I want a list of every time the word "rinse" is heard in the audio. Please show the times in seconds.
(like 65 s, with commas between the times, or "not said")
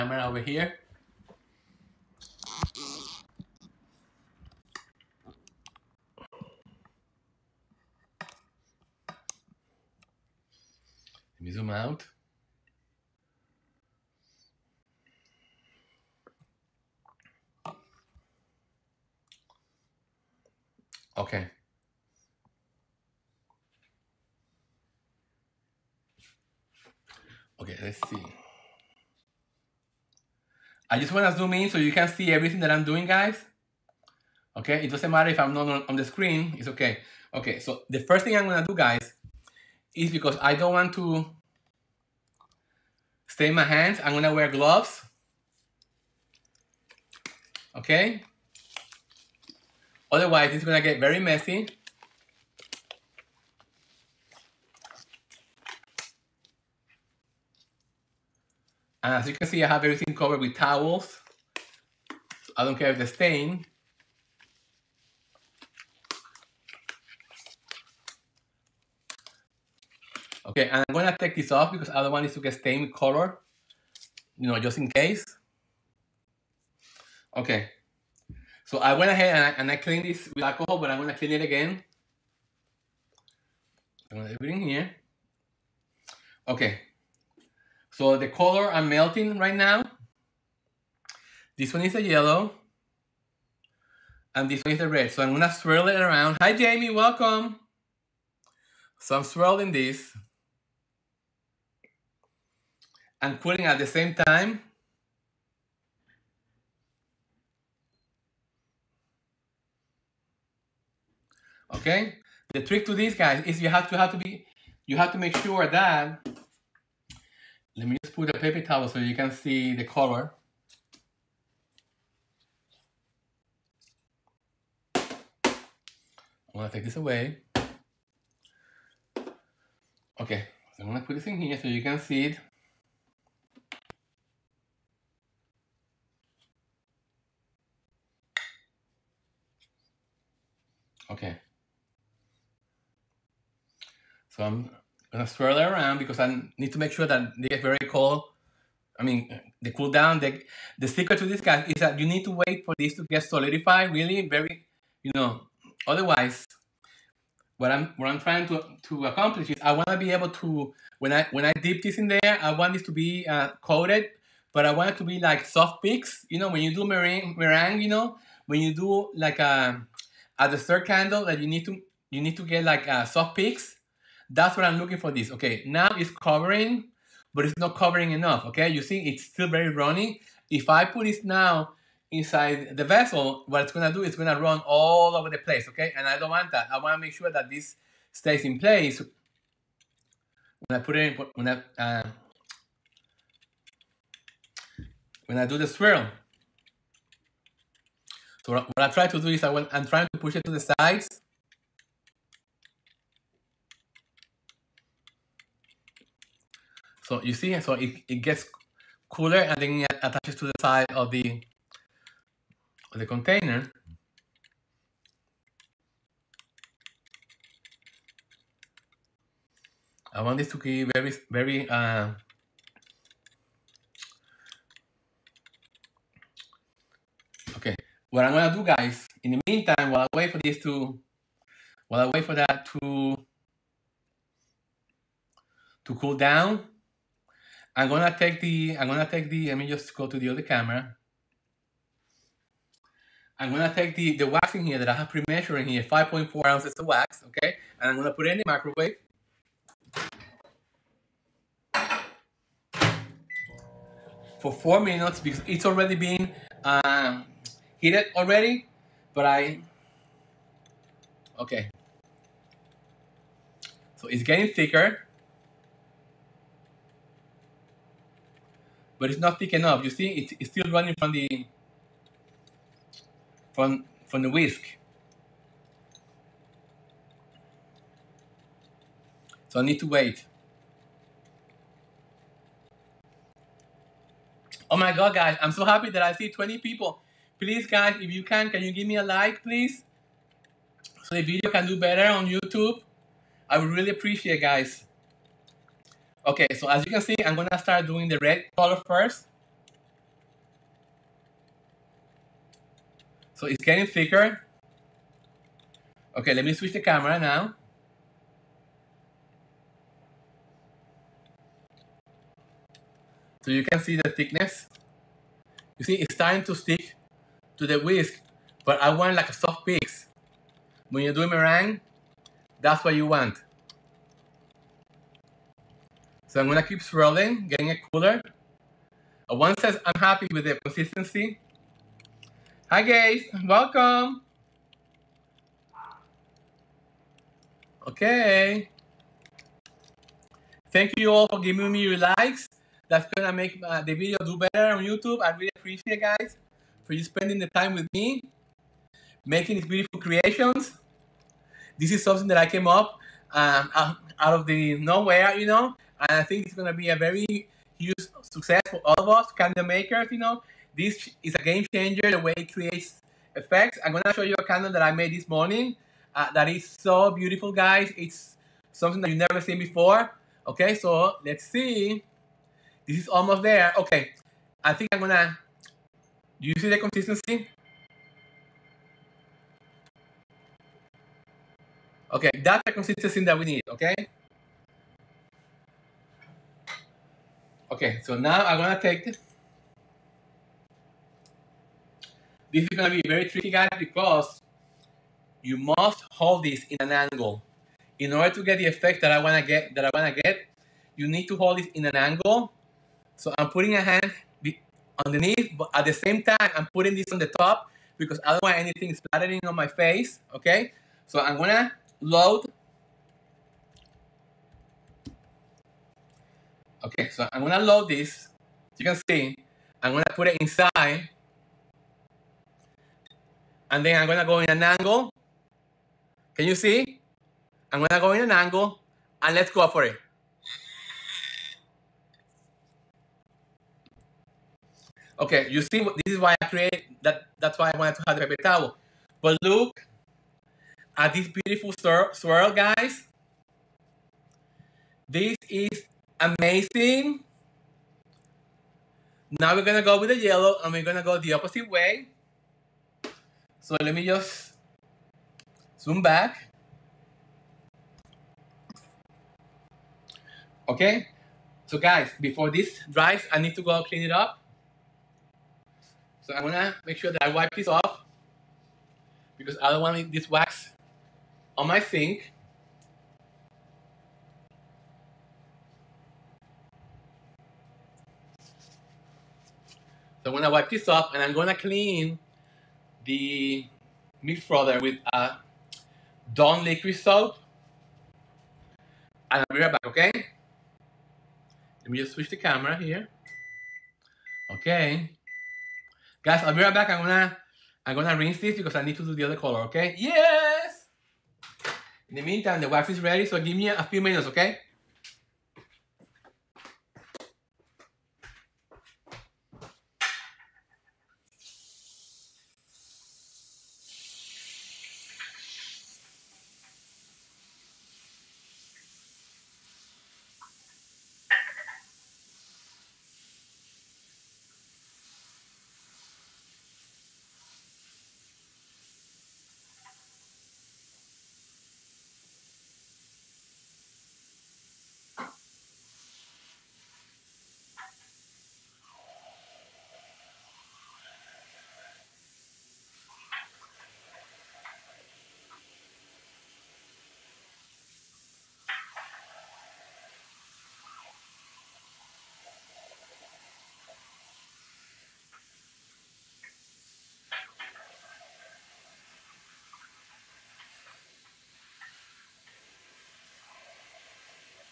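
498 s.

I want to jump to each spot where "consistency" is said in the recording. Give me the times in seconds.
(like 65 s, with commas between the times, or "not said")
330 s, 376 s, 382 s.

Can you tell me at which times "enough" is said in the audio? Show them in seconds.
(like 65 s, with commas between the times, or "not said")
178 s, 269 s.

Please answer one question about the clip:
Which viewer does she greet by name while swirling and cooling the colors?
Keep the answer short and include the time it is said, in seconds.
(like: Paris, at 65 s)
Jamie, at 96 s.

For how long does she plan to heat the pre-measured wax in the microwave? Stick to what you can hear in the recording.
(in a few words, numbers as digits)
4 minutes.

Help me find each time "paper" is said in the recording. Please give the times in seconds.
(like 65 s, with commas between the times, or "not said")
118 s, 438 s.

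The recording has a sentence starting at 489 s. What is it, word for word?
And I'll be right back, okay?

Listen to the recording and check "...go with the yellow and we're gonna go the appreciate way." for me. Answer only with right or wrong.
wrong.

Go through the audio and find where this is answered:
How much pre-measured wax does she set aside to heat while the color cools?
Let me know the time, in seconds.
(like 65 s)
245 s.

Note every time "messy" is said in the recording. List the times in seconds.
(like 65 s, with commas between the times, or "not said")
51 s.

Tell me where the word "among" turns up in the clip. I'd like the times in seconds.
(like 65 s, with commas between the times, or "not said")
not said.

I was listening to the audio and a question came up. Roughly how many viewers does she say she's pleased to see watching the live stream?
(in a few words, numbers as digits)
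20.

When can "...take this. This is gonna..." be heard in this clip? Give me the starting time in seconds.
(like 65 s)
388 s.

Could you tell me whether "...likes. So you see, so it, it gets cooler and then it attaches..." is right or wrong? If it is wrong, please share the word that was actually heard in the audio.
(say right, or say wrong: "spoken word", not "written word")
wrong: "sides", not "likes".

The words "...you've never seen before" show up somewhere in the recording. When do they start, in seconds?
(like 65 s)
369 s.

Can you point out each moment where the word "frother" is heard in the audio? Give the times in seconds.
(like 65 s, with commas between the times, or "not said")
484 s.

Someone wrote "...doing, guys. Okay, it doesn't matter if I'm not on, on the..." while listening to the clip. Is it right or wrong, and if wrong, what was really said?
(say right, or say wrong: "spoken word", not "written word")
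right.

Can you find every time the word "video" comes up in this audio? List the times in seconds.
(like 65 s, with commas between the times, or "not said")
291 s, 343 s.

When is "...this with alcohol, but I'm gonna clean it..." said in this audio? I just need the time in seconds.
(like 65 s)
80 s.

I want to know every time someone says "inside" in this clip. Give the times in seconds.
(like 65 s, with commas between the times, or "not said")
182 s, 420 s.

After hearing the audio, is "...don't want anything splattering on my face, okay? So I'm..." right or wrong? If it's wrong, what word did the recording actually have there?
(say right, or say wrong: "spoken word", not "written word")
right.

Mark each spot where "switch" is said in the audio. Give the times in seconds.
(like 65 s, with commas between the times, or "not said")
306 s, 492 s.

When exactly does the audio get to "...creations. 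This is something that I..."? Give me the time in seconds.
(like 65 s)
350 s.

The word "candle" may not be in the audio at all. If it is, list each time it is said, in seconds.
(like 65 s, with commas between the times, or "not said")
170 s, 359 s, 364 s.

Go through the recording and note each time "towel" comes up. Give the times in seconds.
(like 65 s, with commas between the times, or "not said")
60 s, 118 s, 438 s.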